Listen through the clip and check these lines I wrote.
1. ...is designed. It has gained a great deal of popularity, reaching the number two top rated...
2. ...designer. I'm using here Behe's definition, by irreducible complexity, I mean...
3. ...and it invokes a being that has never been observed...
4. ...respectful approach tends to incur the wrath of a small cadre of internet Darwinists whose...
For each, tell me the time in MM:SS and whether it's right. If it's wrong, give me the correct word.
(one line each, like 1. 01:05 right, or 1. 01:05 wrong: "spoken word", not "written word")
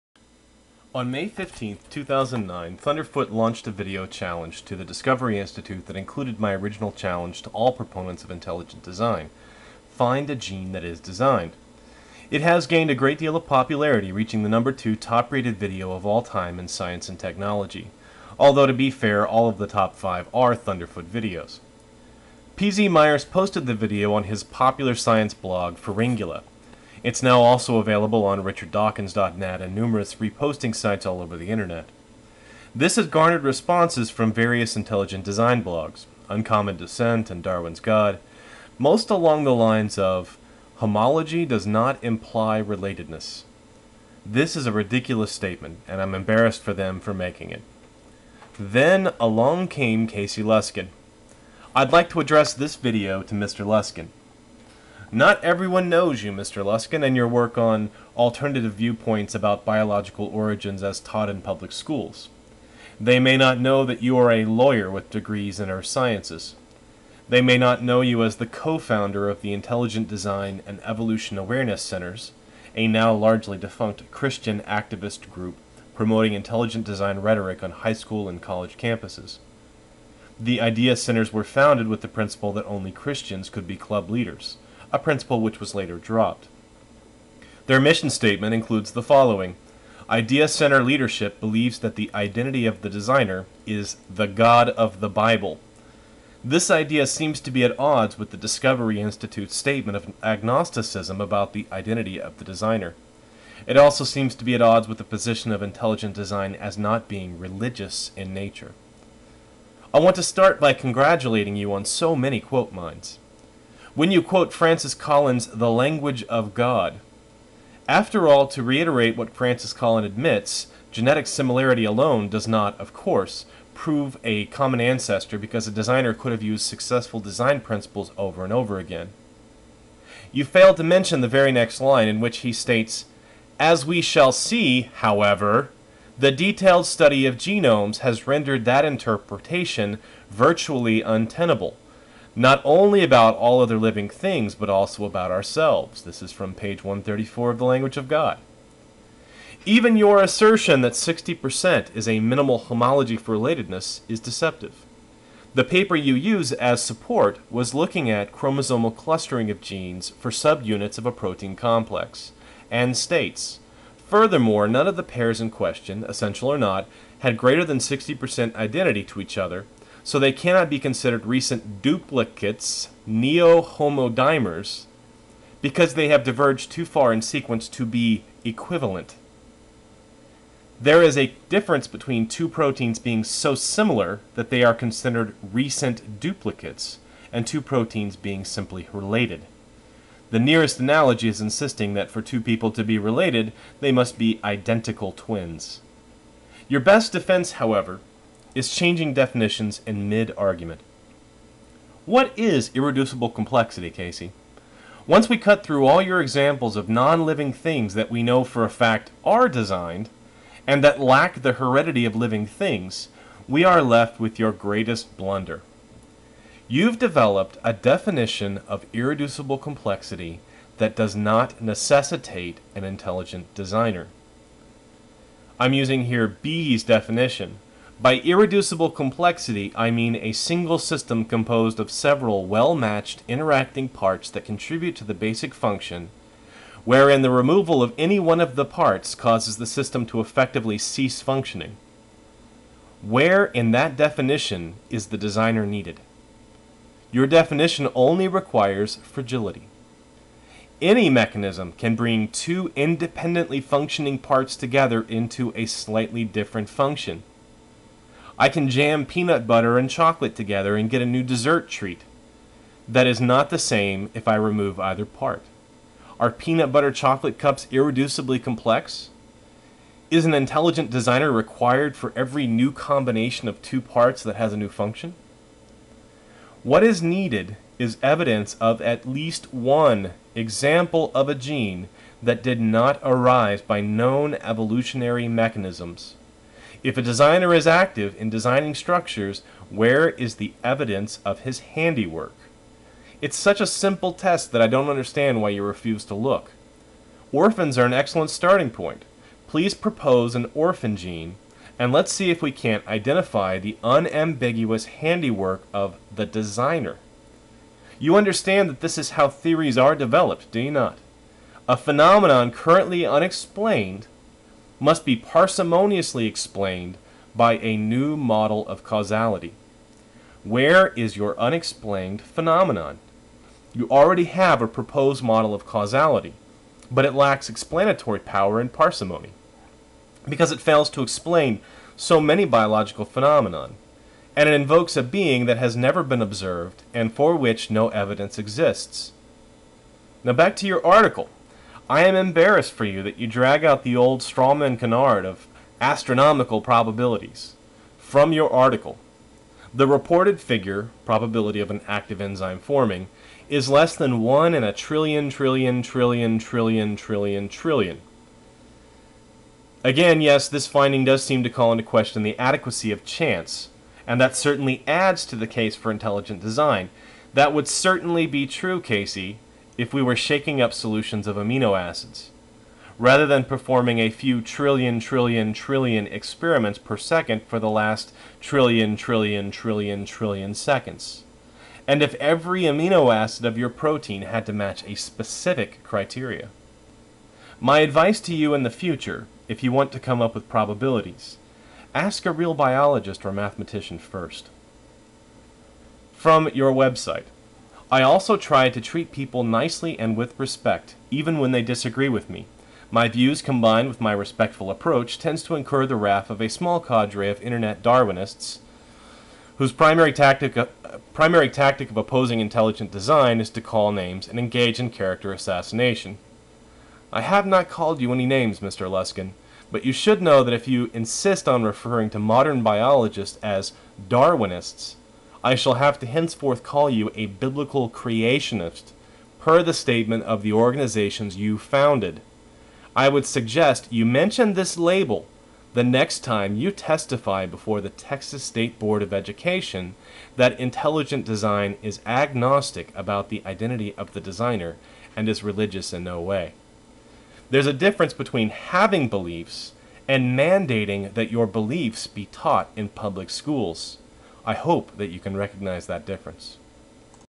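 1. 00:10 right
2. 03:43 right
3. 05:34 right
4. 06:44 right.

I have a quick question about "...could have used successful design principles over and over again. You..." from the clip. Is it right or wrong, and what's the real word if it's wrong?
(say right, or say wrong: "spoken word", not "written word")
right.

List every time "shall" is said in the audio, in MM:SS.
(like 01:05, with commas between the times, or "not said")
02:13, 07:05.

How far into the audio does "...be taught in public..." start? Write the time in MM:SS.
07:32.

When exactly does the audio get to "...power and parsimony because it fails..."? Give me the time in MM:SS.
05:28.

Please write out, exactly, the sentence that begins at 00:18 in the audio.
Although, to be fair, all of the top five are Thunderfoot videos.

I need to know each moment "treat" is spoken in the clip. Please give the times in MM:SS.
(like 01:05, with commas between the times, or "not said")
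04:21, 06:38.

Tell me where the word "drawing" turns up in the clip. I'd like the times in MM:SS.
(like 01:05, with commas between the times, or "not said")
not said.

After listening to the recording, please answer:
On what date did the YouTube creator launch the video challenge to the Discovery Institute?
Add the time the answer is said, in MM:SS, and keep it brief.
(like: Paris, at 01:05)
May 15, 2009, at 00:01.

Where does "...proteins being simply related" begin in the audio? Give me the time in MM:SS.
03:07.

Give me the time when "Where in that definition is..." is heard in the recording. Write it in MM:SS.
04:03.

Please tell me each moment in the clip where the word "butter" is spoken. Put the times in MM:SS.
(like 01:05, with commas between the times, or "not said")
04:19, 04:26.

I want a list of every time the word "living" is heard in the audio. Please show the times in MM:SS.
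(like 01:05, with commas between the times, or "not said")
02:23, 03:26, 03:32.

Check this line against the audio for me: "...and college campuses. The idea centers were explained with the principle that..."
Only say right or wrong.
wrong.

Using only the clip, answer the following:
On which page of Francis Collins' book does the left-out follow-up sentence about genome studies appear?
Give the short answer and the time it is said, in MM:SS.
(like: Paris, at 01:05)
134, at 02:26.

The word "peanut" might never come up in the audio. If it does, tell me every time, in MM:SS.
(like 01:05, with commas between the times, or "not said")
04:19, 04:26.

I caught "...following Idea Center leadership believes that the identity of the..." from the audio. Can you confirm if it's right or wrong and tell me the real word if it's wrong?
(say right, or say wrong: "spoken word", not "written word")
right.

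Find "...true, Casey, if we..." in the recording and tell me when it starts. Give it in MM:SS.
06:08.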